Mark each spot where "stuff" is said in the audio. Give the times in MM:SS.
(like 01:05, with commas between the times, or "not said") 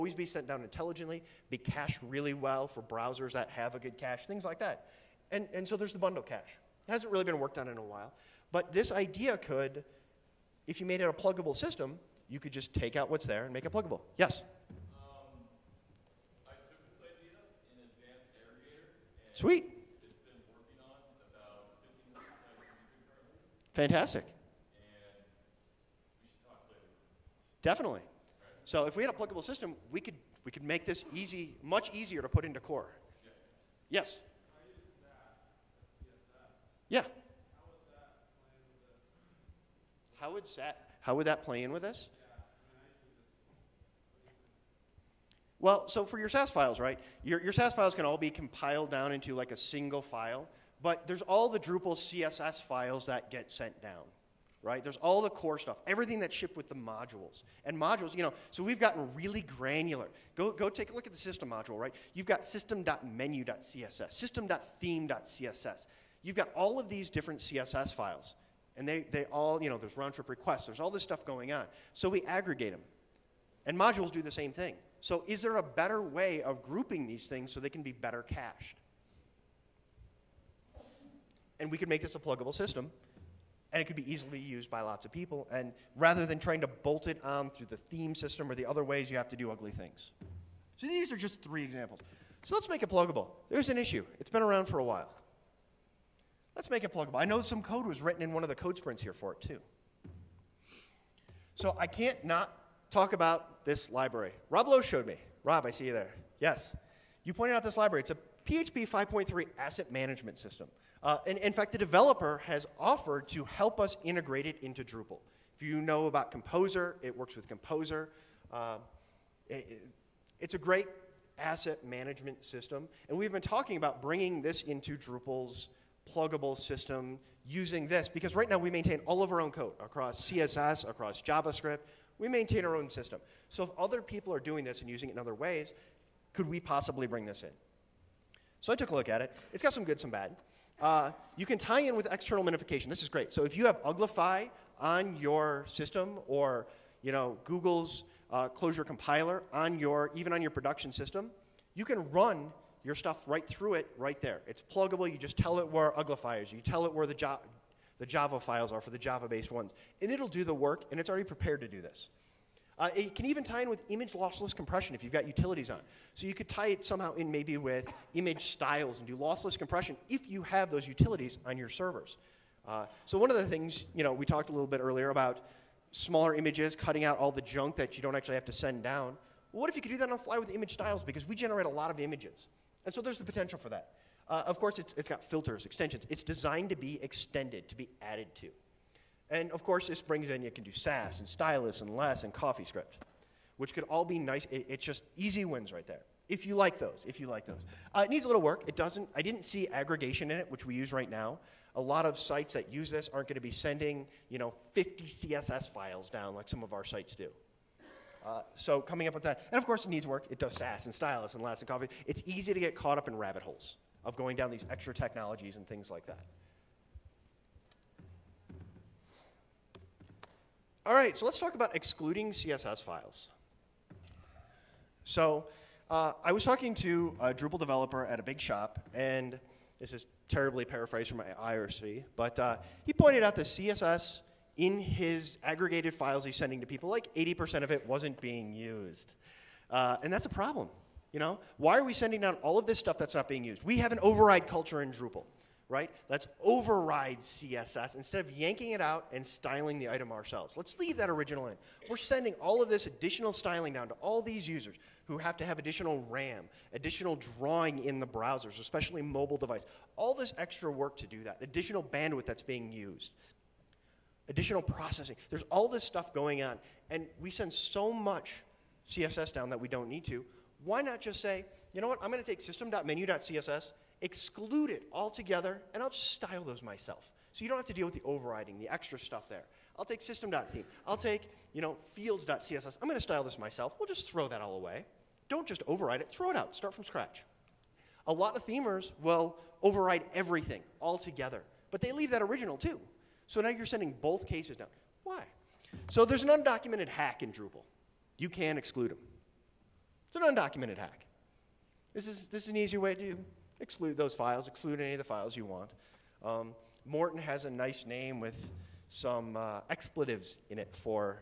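00:55, 01:11, 02:32, 04:02, 04:25, 04:38.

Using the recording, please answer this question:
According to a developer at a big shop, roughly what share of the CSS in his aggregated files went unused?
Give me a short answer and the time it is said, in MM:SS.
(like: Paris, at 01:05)
80%, at 03:57.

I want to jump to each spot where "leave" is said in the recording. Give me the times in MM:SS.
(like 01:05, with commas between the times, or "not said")
04:10, 04:51.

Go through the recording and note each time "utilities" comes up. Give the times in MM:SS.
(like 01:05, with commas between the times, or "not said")
02:45, 02:50.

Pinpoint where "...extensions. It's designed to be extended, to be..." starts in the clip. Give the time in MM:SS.
03:05.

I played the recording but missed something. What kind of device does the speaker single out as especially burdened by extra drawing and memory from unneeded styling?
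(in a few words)
mobile device.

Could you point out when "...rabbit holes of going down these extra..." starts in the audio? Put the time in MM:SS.
03:33.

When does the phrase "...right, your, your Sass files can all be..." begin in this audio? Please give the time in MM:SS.
00:46.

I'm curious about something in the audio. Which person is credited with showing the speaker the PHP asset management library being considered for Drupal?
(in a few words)
Rob Loach.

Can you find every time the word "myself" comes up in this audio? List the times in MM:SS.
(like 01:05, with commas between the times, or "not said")
04:36, 04:43.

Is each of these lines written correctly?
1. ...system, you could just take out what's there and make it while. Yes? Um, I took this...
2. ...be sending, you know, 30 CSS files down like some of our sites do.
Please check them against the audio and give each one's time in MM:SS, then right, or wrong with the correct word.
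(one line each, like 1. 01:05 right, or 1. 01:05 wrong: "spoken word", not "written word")
1. 00:11 wrong: "pluggable", not "while"
2. 03:23 wrong: "50", not "30".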